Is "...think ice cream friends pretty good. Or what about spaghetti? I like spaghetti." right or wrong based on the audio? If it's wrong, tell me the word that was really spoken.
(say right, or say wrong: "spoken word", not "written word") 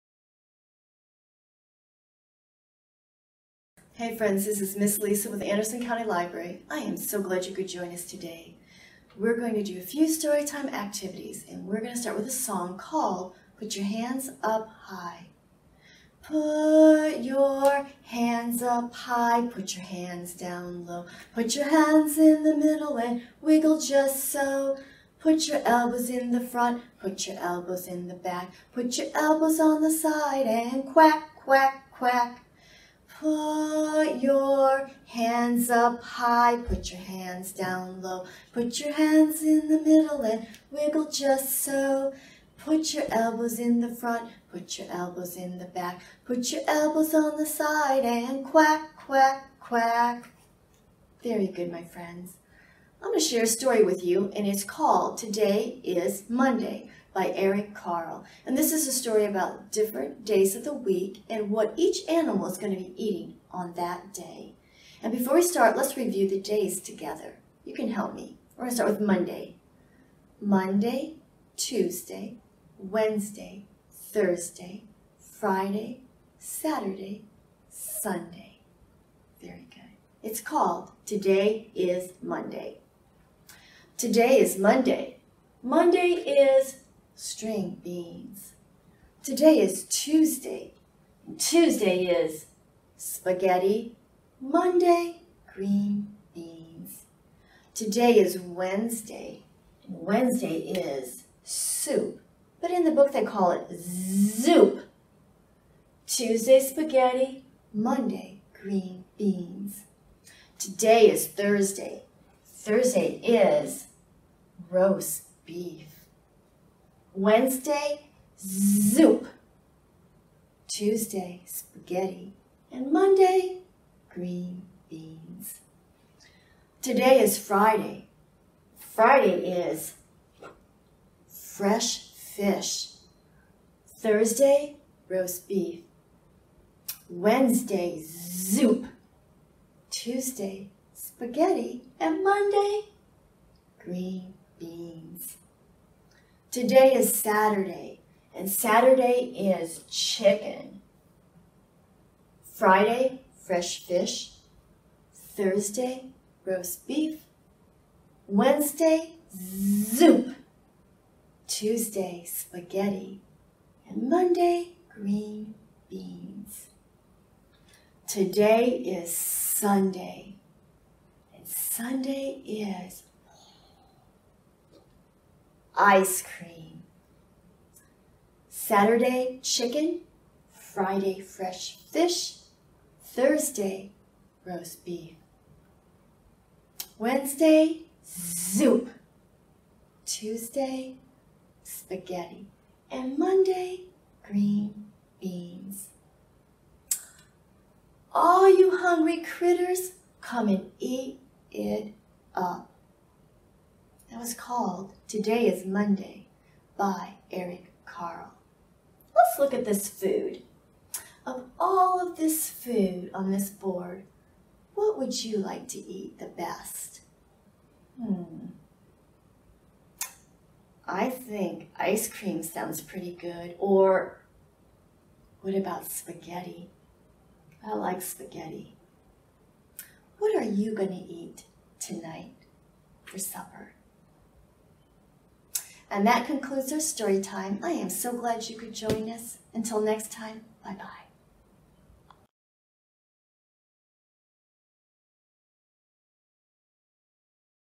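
wrong: "sounds", not "friends".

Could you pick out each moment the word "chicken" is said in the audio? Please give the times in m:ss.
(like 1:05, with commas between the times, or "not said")
2:29, 2:59.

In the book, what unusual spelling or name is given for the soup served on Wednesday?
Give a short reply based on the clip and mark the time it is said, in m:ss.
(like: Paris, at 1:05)
zoop, at 1:43.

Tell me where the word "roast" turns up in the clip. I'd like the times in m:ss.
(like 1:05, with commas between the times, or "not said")
1:54, 2:15, 2:36, 3:04.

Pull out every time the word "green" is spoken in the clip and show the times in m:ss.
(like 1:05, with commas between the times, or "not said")
1:35, 1:48, 2:04, 2:23, 2:44, 3:14.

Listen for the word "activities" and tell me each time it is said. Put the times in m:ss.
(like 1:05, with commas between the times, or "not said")
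0:10.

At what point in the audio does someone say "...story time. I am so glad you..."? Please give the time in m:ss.
3:56.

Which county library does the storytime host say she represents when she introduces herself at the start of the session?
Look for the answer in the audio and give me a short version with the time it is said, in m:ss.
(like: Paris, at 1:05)
Anderson County Library, at 0:05.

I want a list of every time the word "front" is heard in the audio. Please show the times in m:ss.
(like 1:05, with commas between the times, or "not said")
0:26, 0:43.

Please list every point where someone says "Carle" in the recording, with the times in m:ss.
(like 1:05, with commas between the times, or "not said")
0:57, 3:27.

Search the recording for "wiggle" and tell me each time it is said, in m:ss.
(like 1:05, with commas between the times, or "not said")
0:23, 0:40.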